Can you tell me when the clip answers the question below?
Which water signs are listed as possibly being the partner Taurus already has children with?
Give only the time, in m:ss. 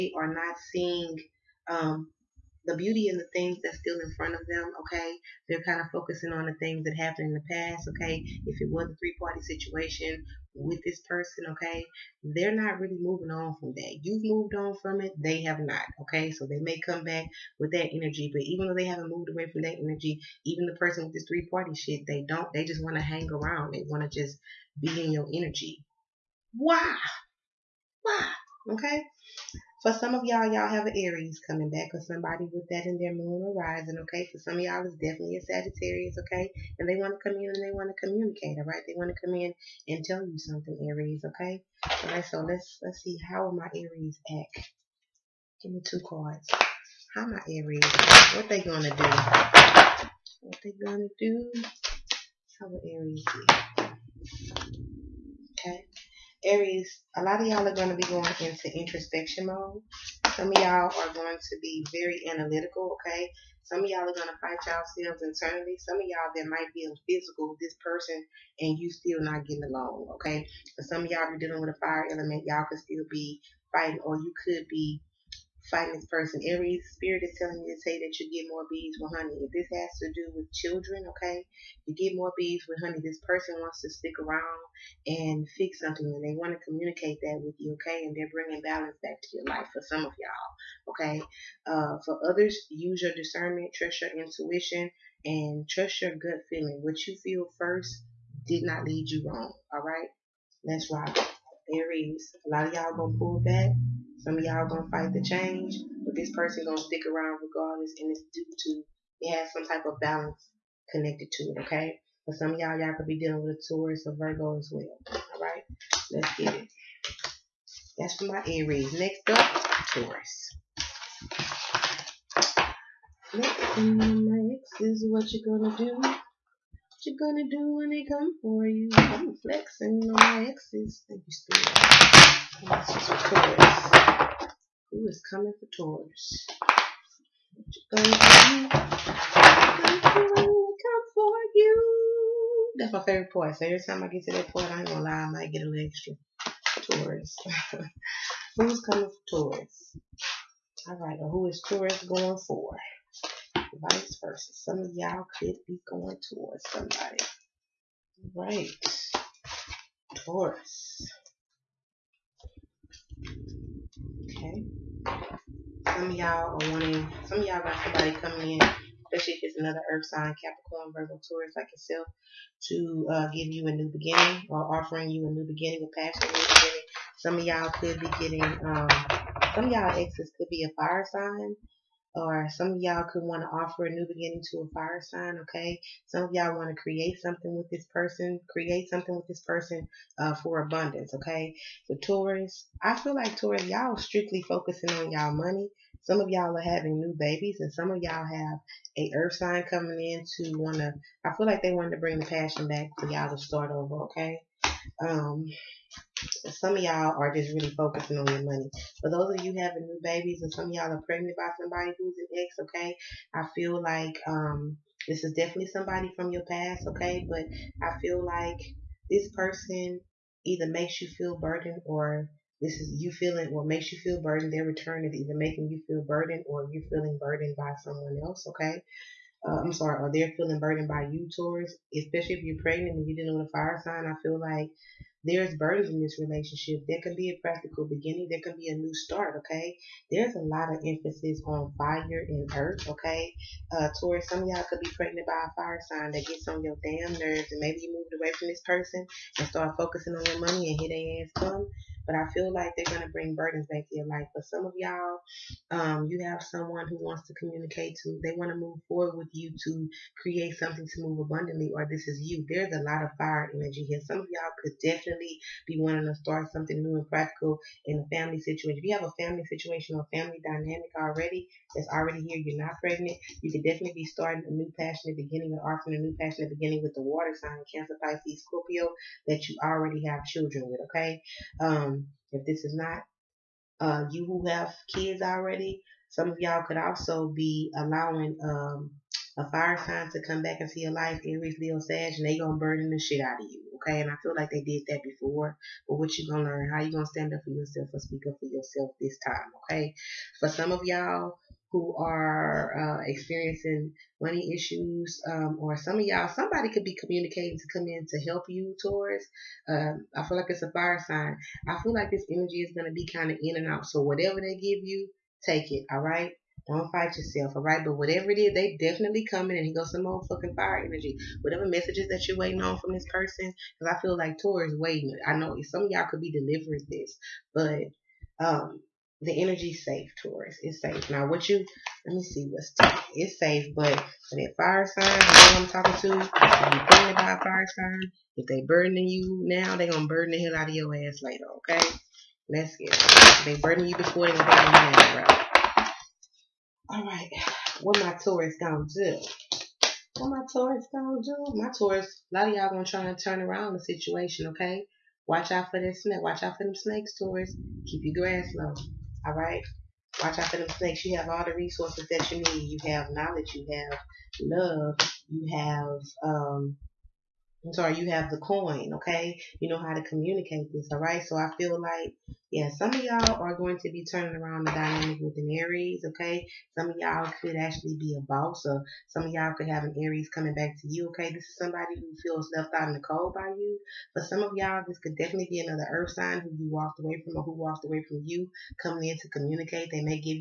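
4:37.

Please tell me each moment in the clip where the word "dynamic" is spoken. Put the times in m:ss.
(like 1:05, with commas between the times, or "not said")
4:30, 6:14.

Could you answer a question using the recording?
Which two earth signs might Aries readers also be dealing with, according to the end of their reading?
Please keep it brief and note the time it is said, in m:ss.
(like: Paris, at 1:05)
Taurus or Virgo, at 1:53.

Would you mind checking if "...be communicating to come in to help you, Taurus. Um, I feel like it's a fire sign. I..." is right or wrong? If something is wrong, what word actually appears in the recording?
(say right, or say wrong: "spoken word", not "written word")
right.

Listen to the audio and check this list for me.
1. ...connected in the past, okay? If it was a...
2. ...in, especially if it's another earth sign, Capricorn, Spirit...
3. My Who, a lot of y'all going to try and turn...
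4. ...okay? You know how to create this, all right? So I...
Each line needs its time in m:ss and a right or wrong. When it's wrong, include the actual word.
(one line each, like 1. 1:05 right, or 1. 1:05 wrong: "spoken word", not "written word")
1. 0:06 wrong: "happened", not "connected"
2. 2:48 wrong: "Virgo", not "Spirit"
3. 5:51 wrong: "Taurus", not "Who"
4. 6:08 wrong: "communicate", not "create".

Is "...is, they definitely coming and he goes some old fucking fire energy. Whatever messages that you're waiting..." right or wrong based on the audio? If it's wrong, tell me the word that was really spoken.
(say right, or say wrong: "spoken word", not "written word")
right.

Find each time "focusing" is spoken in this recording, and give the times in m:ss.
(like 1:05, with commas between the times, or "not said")
0:05, 3:14, 3:27, 4:09.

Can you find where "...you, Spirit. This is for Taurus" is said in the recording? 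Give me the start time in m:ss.
2:11.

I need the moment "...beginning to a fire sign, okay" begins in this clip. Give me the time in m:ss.
3:04.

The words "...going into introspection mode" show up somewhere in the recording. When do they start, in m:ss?
0:58.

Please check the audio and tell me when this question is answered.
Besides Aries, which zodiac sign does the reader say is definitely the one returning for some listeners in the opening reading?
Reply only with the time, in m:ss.
0:34.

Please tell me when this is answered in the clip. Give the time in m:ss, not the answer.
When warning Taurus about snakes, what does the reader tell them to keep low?
5:57.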